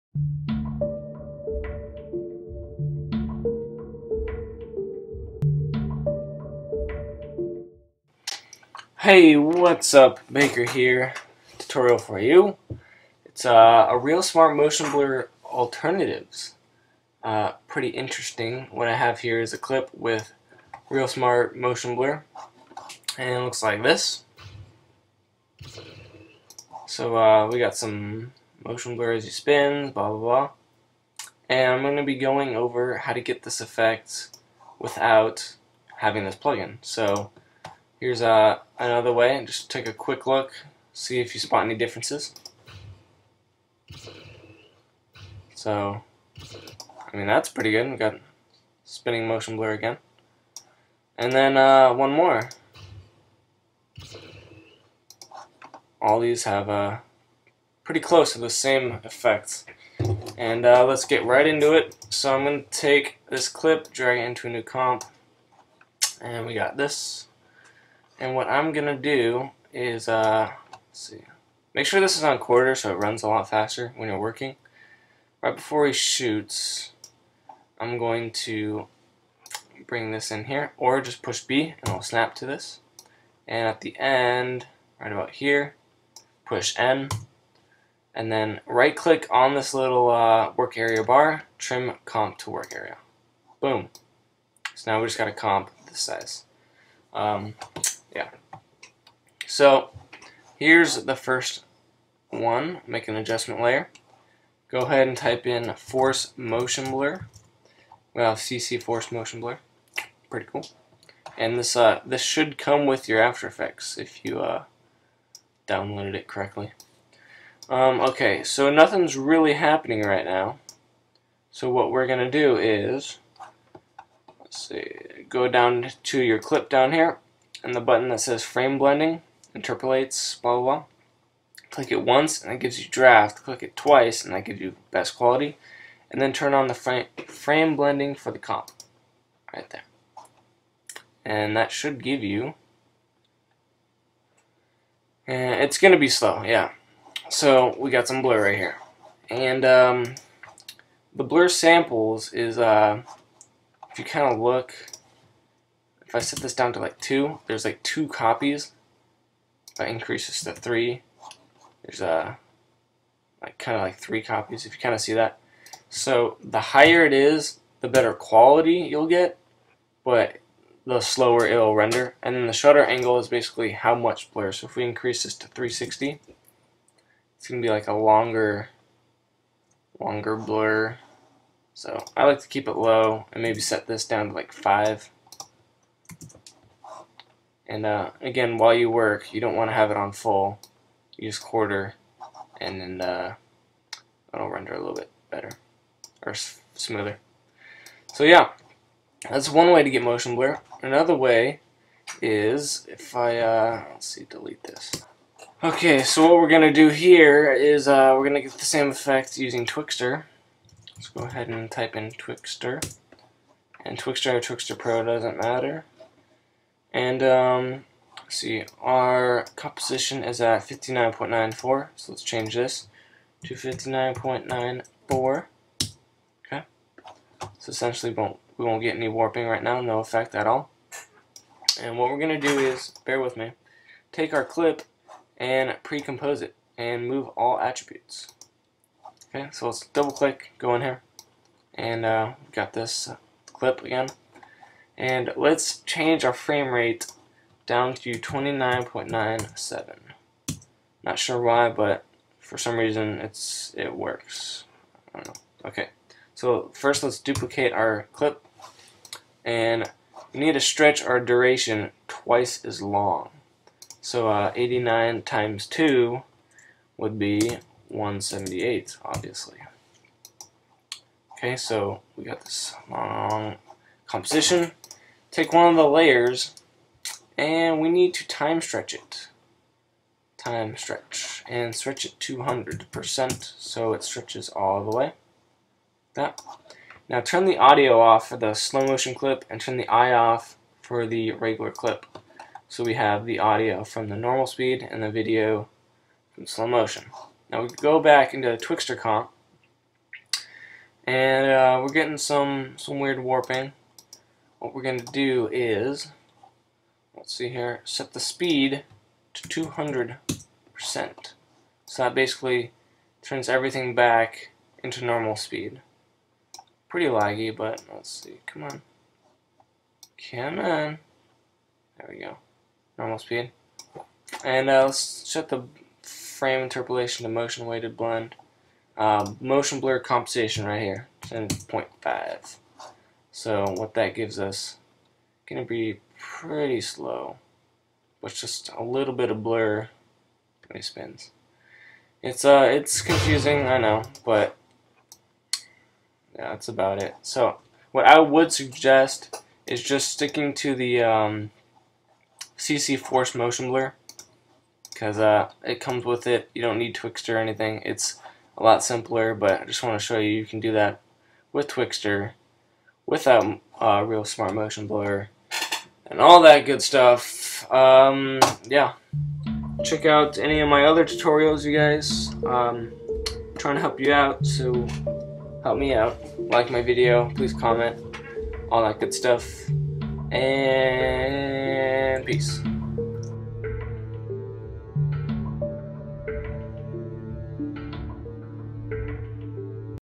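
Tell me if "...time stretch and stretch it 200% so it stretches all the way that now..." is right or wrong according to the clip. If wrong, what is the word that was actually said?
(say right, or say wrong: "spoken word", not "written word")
right.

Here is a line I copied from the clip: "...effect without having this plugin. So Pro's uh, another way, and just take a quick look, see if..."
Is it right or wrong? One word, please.
wrong.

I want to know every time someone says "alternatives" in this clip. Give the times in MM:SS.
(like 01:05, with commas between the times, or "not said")
00:15.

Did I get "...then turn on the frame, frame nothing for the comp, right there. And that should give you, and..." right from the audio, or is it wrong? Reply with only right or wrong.
wrong.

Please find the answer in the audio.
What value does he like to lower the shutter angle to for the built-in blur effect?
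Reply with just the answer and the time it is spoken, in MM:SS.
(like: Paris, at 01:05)
5, at 03:04.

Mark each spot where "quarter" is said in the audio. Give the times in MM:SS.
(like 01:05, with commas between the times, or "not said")
01:12, 03:11.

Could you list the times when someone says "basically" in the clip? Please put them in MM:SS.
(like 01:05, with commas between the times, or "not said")
02:53, 05:12.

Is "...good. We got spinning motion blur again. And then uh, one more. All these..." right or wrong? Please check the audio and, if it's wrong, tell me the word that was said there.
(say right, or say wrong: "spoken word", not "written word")
right.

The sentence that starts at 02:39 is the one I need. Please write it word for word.
If I increase this to 3, there's a uh, like kind of like 3 copies, if you kind of see that.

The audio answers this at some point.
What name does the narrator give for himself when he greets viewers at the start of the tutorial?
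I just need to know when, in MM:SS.
00:10.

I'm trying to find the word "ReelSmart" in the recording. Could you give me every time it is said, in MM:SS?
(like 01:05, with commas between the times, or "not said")
00:13, 00:20, 06:04.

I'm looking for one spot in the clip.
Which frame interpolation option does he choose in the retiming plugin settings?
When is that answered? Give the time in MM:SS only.
05:27.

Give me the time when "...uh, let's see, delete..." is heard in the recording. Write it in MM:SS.
03:23.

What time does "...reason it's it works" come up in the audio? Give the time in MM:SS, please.
04:12.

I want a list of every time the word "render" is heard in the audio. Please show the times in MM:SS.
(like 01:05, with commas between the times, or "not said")
02:51, 03:14.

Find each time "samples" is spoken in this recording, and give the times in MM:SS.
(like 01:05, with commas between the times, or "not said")
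02:31.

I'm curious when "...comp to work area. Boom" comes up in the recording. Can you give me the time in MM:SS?
01:32.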